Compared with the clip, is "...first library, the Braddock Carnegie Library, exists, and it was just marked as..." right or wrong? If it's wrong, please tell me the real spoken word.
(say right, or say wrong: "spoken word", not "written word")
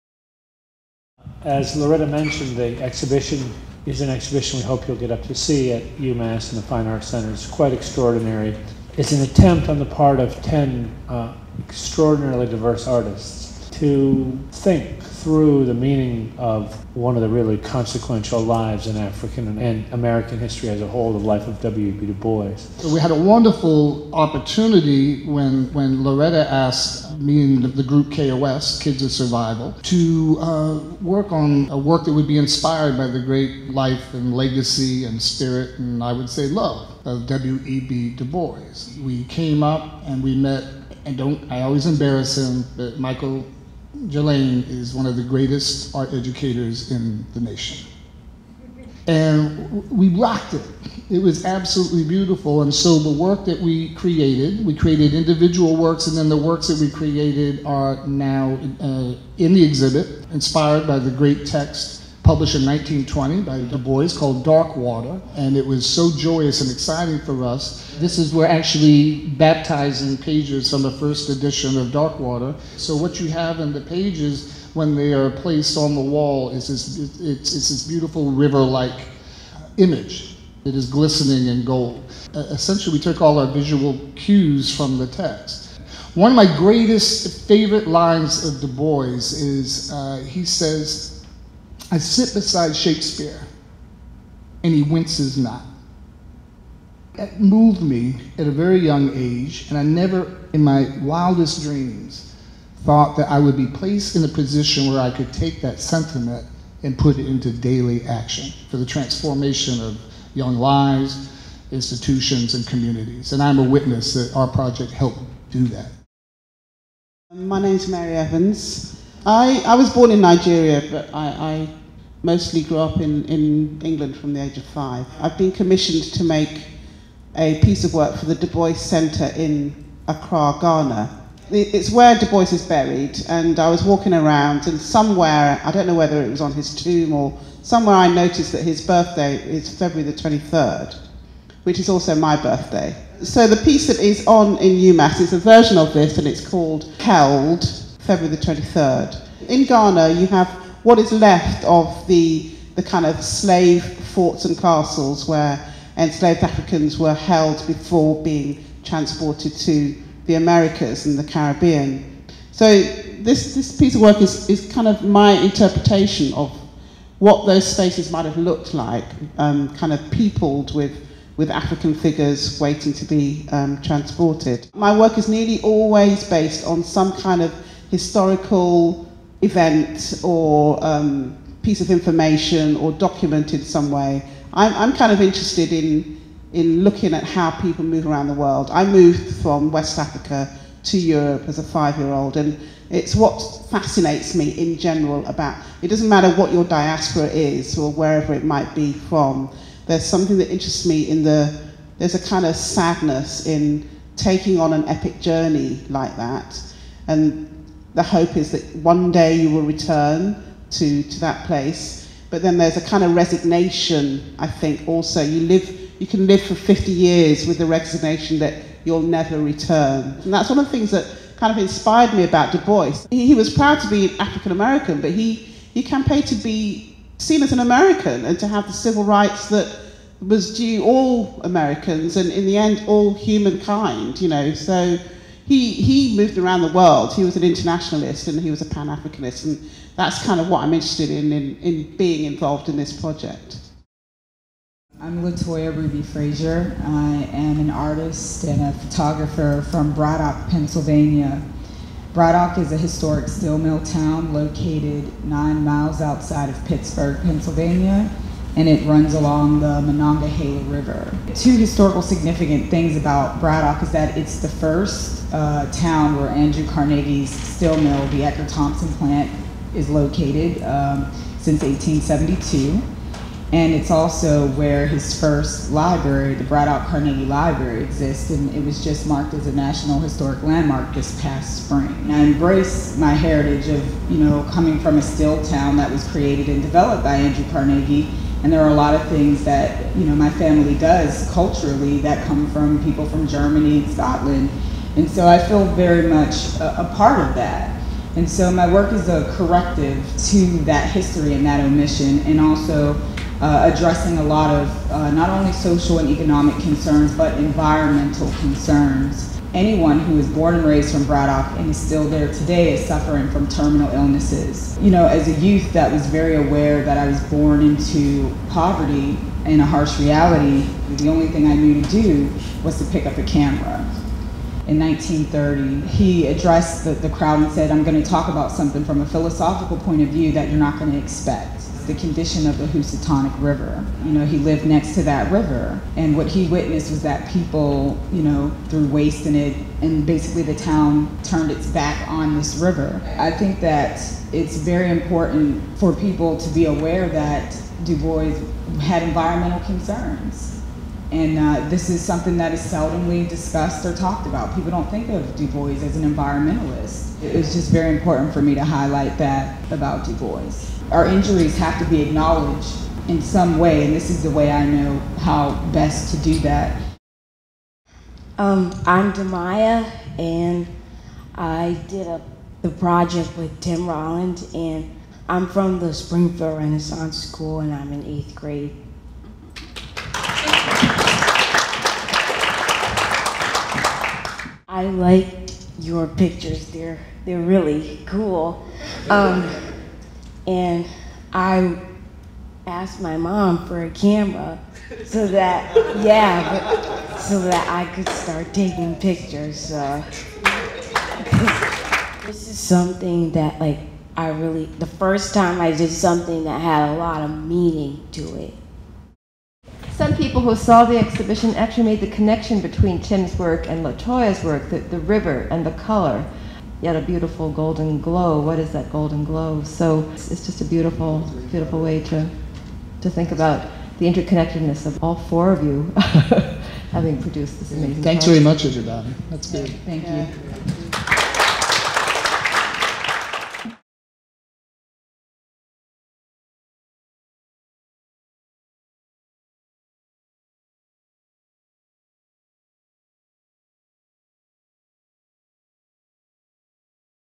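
right.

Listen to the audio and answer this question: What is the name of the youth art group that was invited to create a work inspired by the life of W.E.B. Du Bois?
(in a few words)
Kids of Survival.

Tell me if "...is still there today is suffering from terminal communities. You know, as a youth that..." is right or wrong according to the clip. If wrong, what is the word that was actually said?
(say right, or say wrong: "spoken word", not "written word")
wrong: "illnesses", not "communities".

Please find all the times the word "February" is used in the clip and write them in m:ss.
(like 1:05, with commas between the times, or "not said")
2:19, 2:27.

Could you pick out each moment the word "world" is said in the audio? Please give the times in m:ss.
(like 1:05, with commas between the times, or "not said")
3:08, 3:56.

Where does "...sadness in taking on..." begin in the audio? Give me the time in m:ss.
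3:22.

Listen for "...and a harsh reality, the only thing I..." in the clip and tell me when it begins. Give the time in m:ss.
5:19.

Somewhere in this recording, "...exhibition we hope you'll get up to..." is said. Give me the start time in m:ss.
0:04.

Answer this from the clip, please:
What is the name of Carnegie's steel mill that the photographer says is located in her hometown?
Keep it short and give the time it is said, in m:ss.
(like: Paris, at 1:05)
Edgar Thomson plant, at 4:28.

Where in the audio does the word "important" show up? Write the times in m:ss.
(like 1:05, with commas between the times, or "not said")
5:44, 5:57.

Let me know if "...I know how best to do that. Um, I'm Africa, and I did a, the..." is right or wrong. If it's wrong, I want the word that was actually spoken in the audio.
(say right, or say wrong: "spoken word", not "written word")
wrong: "Demaya", not "Africa".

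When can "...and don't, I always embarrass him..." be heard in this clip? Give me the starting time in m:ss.
0:41.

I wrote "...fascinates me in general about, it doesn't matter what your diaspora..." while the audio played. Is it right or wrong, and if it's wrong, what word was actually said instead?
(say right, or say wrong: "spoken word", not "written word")
right.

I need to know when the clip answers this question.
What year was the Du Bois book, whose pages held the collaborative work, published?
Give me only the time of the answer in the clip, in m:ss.
1:02.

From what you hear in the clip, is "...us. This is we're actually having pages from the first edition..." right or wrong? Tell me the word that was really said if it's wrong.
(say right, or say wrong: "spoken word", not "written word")
wrong: "baptizing", not "having".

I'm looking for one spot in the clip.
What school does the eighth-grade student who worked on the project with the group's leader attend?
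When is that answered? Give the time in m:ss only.
6:15.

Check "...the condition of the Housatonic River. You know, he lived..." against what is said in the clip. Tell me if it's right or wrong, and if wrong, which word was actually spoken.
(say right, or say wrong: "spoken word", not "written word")
right.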